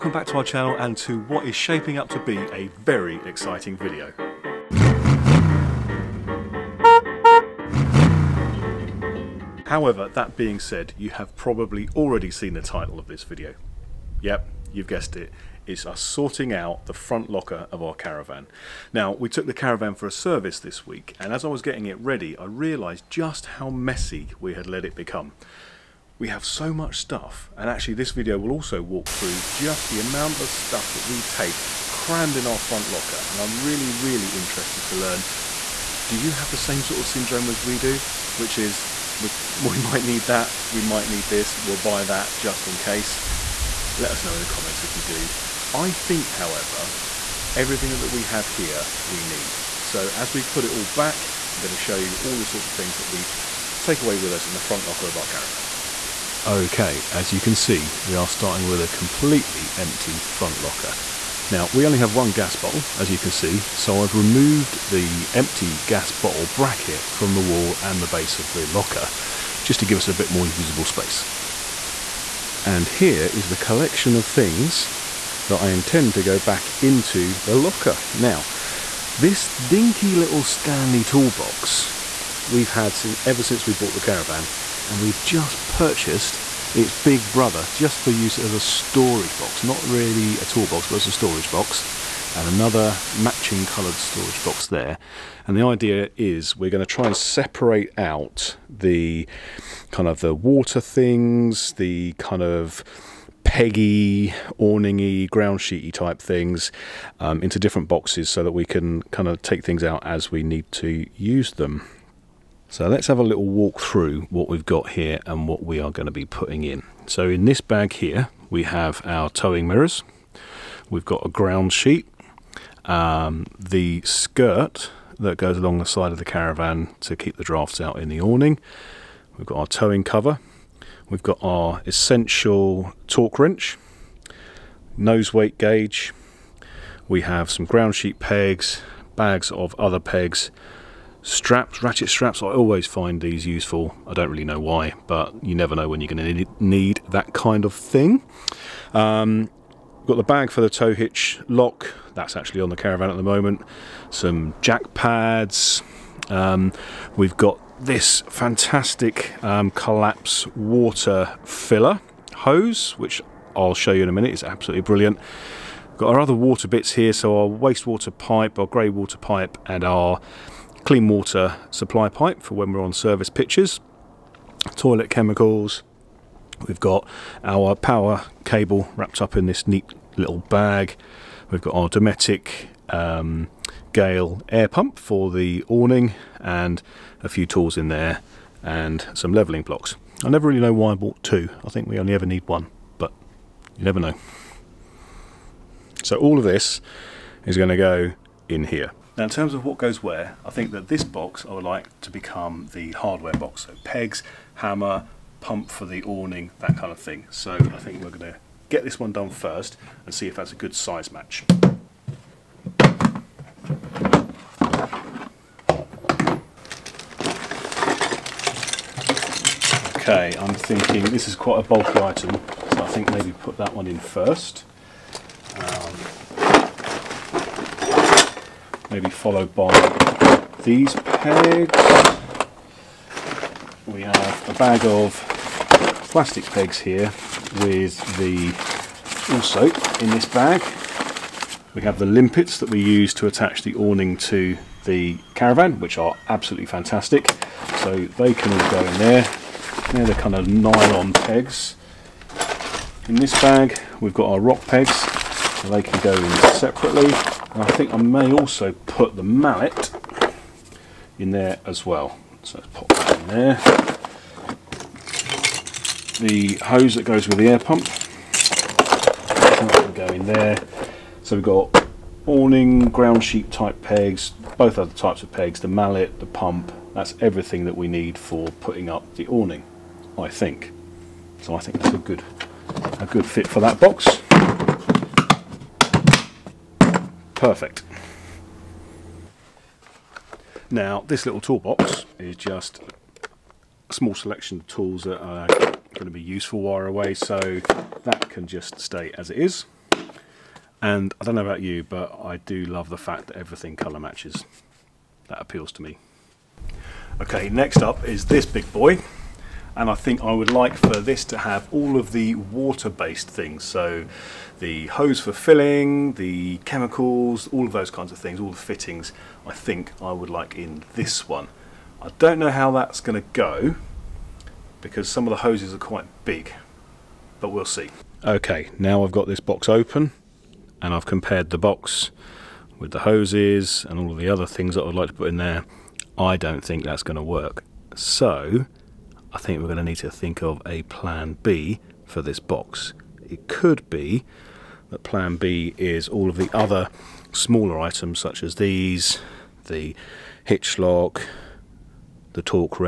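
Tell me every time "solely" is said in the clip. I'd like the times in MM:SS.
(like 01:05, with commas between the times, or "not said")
not said.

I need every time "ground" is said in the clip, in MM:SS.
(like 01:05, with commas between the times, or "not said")
01:45, 02:01, 02:17, 04:32.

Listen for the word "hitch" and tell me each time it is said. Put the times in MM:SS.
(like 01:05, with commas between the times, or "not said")
02:30, 05:50.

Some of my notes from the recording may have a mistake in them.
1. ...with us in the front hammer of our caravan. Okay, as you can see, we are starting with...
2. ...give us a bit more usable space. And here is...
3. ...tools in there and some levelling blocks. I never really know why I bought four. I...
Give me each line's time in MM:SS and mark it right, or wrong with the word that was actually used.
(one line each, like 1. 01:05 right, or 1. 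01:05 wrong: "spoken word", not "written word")
1. 00:54 wrong: "locker", not "hammer"
2. 01:09 right
3. 03:07 wrong: "two", not "four".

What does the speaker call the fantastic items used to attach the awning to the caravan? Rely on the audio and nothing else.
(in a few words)
Limpets.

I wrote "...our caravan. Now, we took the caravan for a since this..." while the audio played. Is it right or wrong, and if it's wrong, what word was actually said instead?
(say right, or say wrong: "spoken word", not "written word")
wrong: "service", not "since".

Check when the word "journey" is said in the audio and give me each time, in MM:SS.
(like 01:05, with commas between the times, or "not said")
not said.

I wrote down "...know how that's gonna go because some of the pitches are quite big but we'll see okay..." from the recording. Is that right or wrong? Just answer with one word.
wrong.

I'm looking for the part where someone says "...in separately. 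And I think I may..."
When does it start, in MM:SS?
04:16.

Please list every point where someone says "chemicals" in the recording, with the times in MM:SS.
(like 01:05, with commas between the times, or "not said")
02:55, 05:16.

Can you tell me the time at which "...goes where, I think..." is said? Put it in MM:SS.
03:19.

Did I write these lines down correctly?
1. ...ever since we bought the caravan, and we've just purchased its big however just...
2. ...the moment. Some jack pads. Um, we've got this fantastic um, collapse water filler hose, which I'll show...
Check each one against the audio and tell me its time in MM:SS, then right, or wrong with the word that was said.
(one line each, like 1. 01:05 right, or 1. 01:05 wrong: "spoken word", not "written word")
1. 01:23 wrong: "brother", not "however"
2. 02:33 right.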